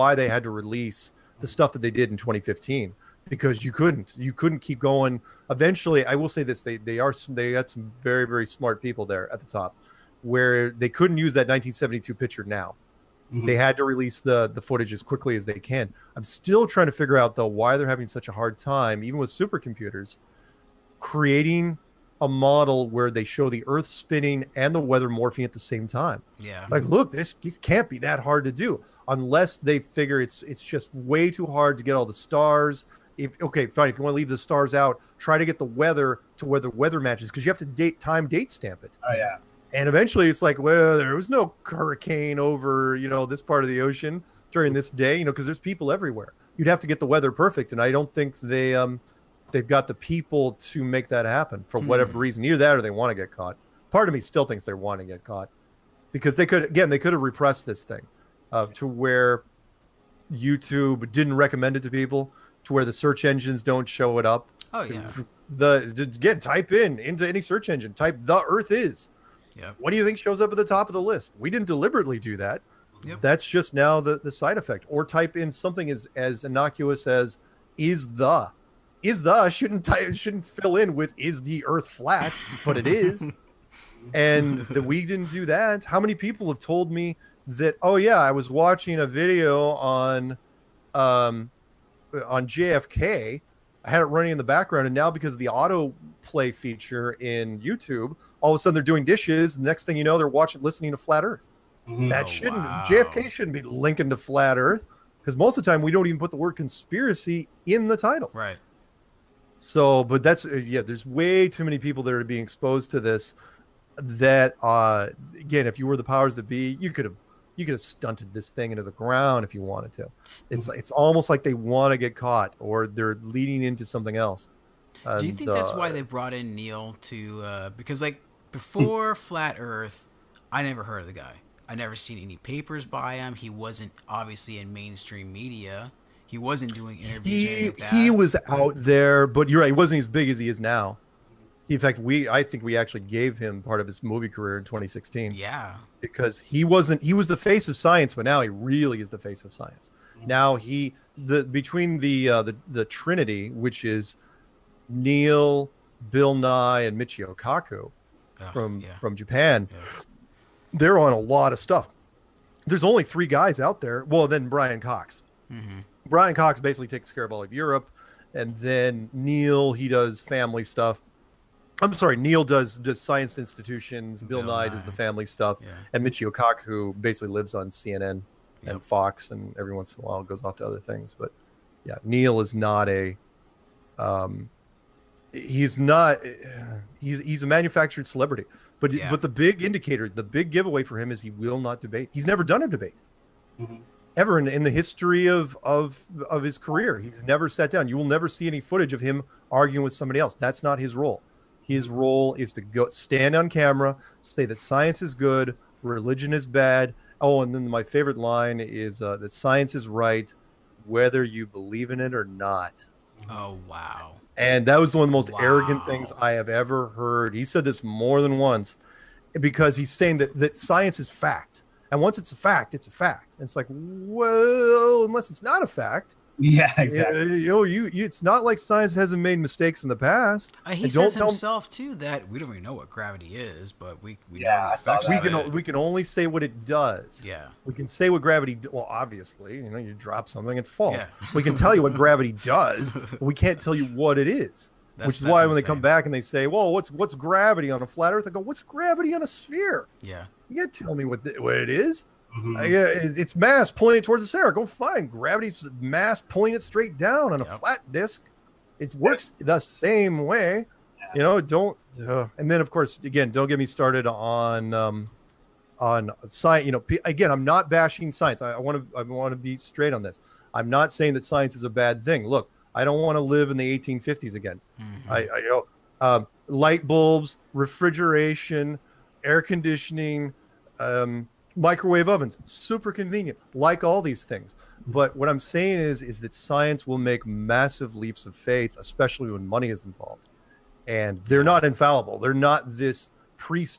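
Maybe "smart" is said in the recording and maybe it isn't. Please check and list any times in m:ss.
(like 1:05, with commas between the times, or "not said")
0:08.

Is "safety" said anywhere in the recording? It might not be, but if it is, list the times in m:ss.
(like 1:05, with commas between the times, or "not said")
not said.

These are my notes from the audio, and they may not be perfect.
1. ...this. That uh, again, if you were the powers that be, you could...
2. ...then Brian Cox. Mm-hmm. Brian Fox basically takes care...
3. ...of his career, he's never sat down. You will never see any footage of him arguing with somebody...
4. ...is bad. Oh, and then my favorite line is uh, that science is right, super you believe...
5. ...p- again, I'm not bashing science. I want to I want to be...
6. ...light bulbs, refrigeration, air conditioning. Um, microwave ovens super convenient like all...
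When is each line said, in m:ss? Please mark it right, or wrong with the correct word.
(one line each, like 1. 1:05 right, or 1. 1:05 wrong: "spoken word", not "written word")
1. 1:52 right
2. 2:44 wrong: "Cox", not "Fox"
3. 3:16 right
4. 3:26 wrong: "whether", not "super"
5. 4:26 right
6. 4:36 right.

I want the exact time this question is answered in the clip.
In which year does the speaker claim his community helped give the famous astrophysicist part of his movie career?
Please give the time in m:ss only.
2:24.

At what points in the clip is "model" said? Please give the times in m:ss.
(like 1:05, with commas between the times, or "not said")
0:22.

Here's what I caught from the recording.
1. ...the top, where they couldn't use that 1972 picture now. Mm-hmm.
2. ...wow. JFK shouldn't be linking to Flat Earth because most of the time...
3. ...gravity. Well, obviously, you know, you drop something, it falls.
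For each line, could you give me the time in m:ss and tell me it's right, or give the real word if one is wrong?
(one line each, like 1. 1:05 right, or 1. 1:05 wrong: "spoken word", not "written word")
1. 0:09 right
2. 1:42 right
3. 3:58 right.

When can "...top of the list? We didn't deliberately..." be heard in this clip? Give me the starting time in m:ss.
1:10.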